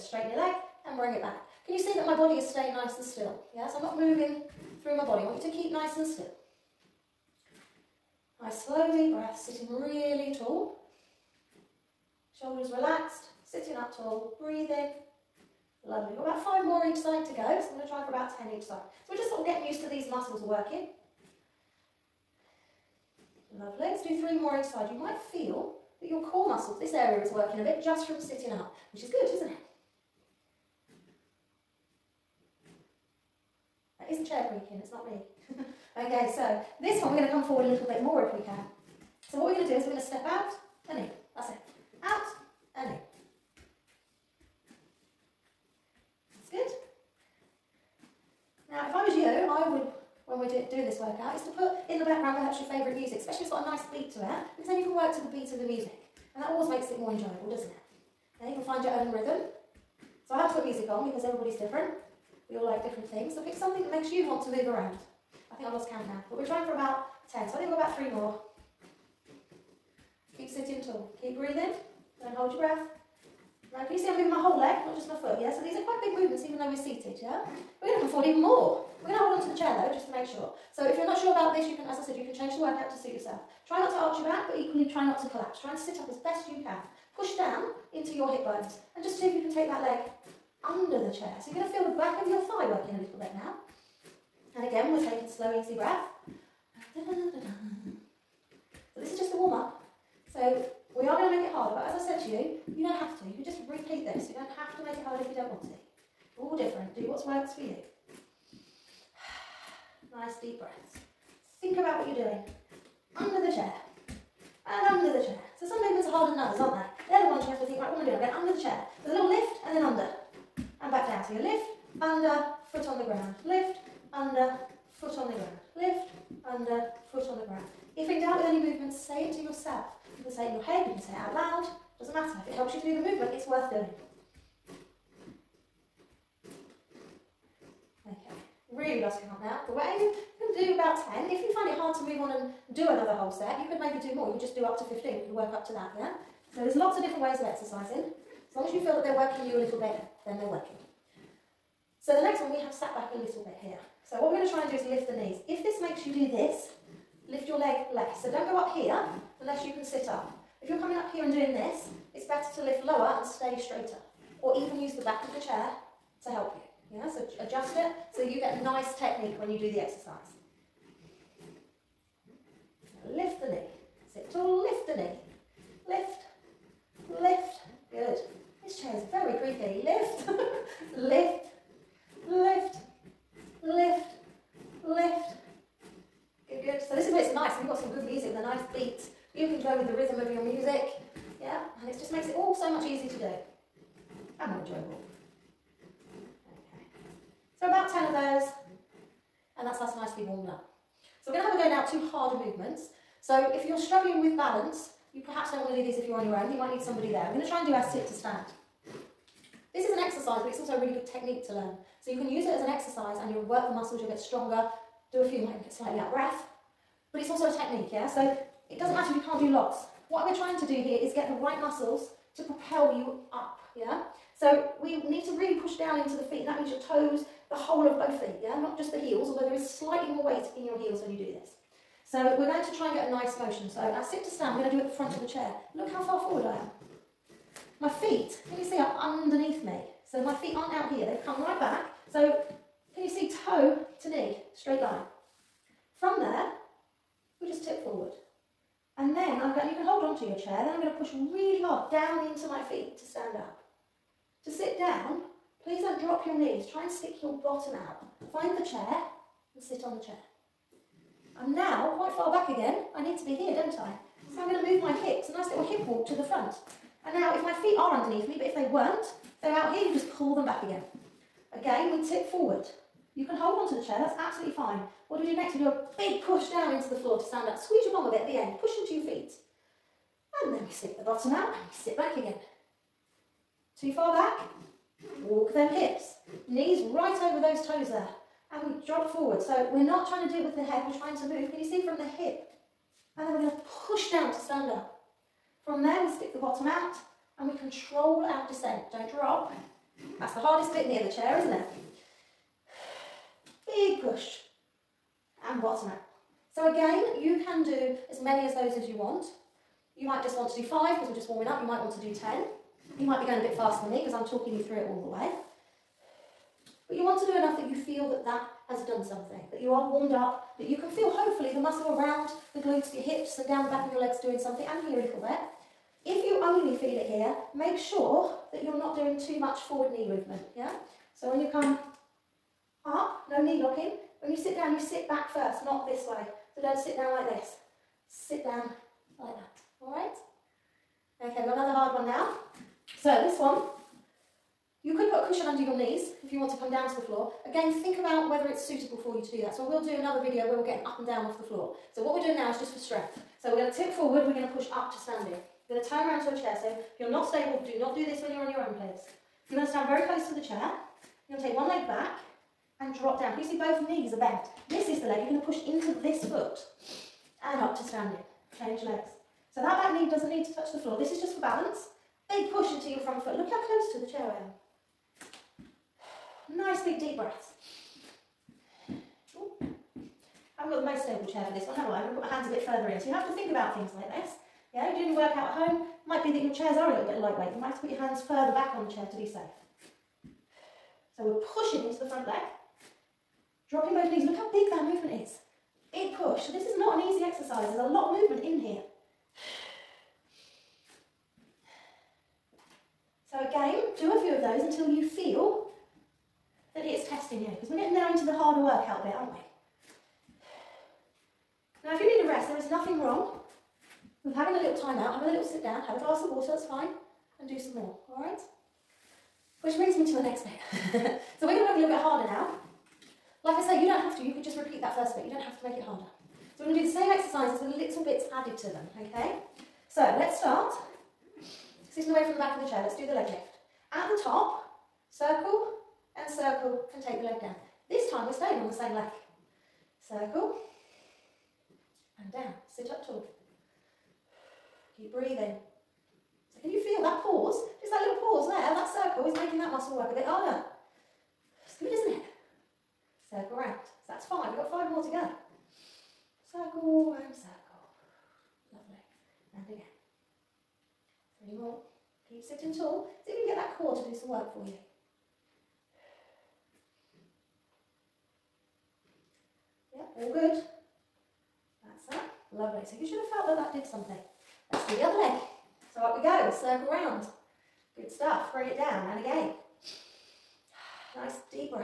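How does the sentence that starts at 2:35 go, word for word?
If this makes you do this, lift your leg less.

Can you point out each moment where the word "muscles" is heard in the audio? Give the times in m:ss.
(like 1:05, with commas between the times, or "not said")
0:20, 0:26, 3:33, 3:41, 5:21, 7:29.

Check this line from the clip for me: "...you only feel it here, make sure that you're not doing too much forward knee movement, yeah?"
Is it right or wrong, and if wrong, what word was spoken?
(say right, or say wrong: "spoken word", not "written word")
right.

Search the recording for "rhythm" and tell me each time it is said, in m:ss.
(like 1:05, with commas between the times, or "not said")
0:59, 3:09.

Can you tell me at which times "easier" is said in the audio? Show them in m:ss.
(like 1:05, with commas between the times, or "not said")
3:12.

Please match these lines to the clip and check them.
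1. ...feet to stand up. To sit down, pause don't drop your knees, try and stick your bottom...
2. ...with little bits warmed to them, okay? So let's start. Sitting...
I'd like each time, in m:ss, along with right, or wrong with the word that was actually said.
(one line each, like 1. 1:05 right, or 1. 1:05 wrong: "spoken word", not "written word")
1. 4:12 wrong: "please", not "pause"
2. 7:07 wrong: "added", not "warmed".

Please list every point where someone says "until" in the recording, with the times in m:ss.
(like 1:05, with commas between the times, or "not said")
6:44.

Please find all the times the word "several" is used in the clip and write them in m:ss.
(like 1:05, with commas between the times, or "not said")
not said.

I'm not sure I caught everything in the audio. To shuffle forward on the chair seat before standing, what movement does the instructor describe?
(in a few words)
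hip walk.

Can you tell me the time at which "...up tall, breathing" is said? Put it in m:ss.
0:13.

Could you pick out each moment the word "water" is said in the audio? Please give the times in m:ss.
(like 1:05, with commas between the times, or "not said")
6:56.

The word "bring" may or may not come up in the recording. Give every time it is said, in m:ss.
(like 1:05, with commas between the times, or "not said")
0:00, 6:59.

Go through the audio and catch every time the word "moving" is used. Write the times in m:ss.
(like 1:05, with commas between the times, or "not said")
0:03, 1:14.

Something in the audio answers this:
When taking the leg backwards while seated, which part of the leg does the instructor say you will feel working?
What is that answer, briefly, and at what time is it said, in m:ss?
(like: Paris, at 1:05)
back of your thigh, at 1:31.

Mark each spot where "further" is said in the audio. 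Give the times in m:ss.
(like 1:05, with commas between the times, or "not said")
6:22, 6:28.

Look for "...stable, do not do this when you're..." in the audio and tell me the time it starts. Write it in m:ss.
5:57.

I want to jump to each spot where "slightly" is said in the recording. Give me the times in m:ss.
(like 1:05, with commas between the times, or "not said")
3:35, 3:49.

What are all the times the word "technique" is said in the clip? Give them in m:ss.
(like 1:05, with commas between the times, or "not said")
2:48, 3:31, 3:37.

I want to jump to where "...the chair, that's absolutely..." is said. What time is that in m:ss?
4:33.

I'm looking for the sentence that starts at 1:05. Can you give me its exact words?
I think I've lost count now.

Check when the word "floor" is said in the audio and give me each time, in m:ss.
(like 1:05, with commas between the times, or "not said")
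4:36, 5:47, 5:51, 6:10.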